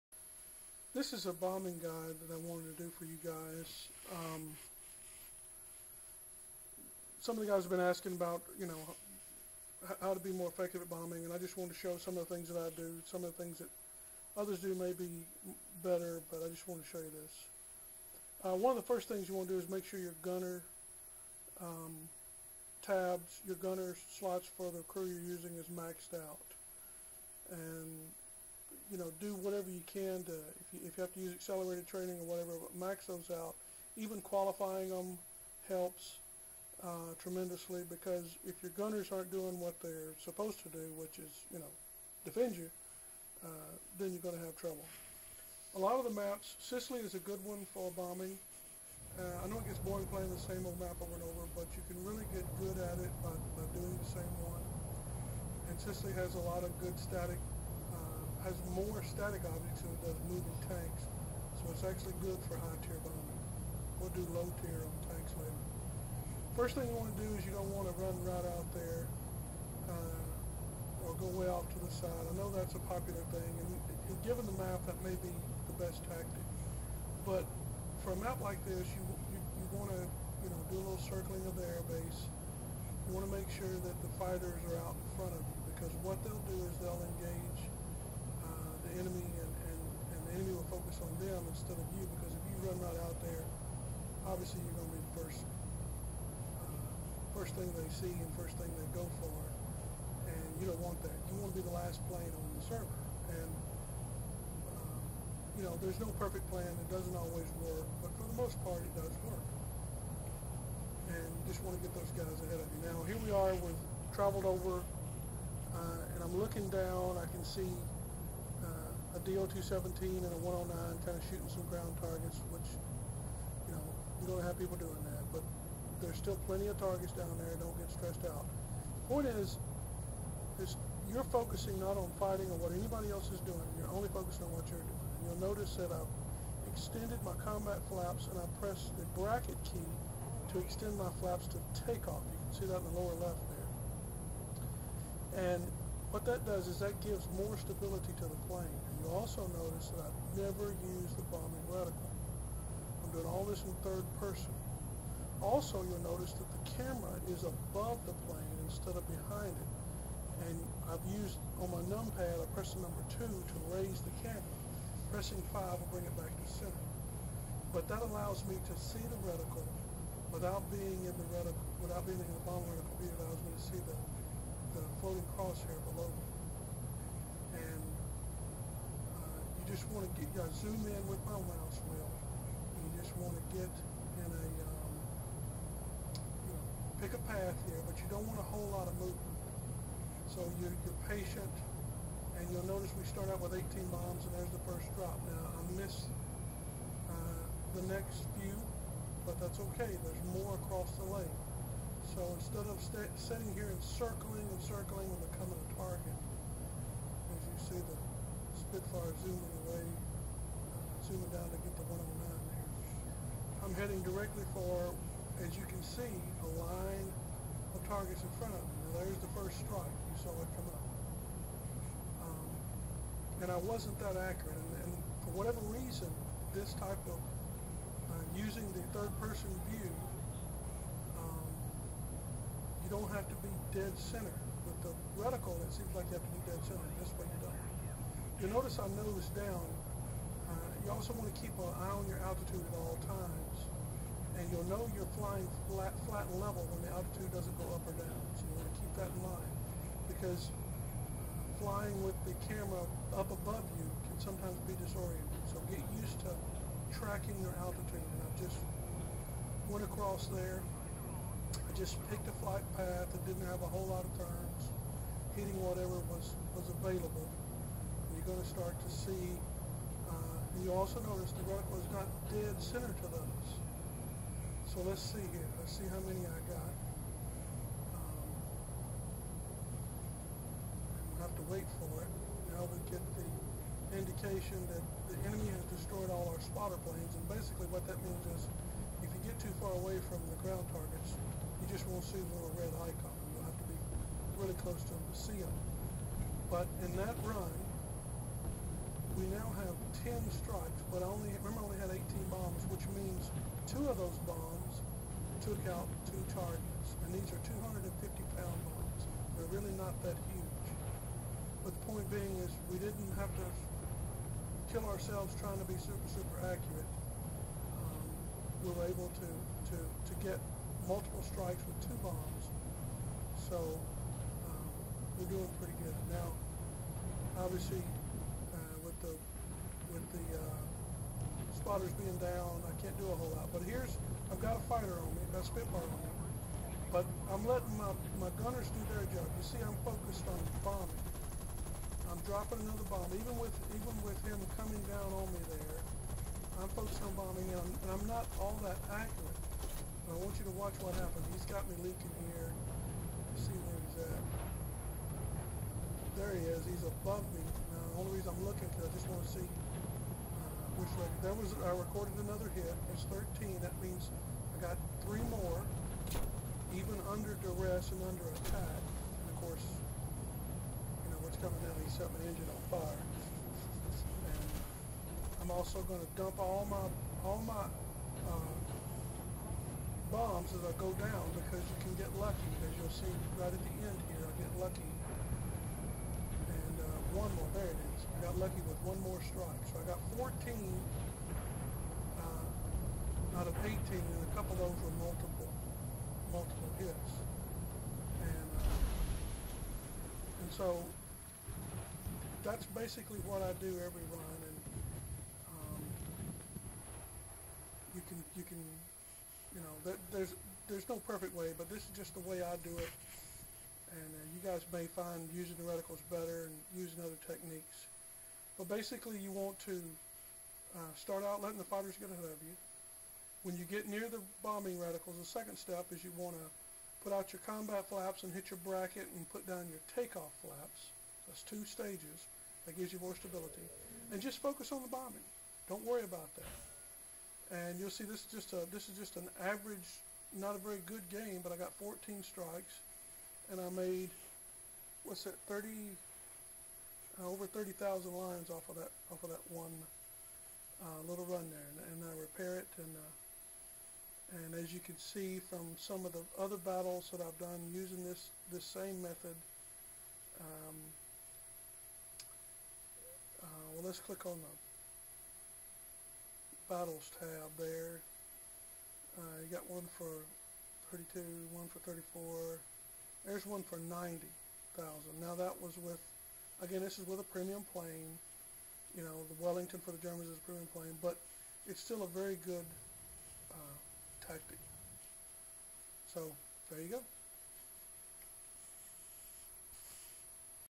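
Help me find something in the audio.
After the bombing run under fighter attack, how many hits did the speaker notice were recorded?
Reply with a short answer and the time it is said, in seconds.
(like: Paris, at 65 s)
13, at 362 s.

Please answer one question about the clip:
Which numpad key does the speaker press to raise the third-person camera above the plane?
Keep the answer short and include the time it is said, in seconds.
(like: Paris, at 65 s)
2, at 162 s.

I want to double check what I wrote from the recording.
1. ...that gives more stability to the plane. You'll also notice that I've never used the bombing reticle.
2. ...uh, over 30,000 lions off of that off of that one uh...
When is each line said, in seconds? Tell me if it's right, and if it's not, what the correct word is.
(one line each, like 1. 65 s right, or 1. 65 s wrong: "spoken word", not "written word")
1. 146 s right
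2. 447 s right.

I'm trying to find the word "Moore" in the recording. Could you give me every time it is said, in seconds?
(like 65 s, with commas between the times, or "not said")
not said.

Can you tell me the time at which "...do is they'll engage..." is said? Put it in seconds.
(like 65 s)
86 s.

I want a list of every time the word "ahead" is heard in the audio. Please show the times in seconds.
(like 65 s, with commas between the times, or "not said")
112 s, 422 s.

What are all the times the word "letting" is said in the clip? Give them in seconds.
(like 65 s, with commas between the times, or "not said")
337 s, 421 s.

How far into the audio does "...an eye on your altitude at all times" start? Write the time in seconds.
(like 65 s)
241 s.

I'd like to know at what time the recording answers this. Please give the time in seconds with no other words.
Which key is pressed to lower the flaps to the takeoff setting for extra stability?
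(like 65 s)
139 s.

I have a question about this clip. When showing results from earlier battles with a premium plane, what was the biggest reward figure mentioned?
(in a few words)
90,000.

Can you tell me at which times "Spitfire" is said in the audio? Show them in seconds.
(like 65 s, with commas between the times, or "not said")
208 s, 335 s.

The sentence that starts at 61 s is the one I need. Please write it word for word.
So it's actually good for high tier bombing.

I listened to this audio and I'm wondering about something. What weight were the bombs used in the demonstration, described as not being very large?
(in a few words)
250 pounds.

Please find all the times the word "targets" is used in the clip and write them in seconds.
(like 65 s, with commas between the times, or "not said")
122 s, 126 s, 205 s, 217 s, 290 s, 306 s.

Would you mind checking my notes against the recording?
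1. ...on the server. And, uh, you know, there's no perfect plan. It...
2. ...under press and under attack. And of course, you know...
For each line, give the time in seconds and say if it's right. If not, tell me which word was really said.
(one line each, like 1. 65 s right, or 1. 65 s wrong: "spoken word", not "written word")
1. 102 s right
2. 367 s wrong: "duress", not "press".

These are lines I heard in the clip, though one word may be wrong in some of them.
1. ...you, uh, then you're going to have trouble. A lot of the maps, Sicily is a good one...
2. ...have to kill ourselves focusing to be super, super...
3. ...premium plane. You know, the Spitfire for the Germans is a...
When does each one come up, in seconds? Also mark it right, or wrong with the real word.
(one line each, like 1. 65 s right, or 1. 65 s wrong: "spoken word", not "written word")
1. 42 s right
2. 313 s wrong: "trying", not "focusing"
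3. 477 s wrong: "Wellington", not "Spitfire".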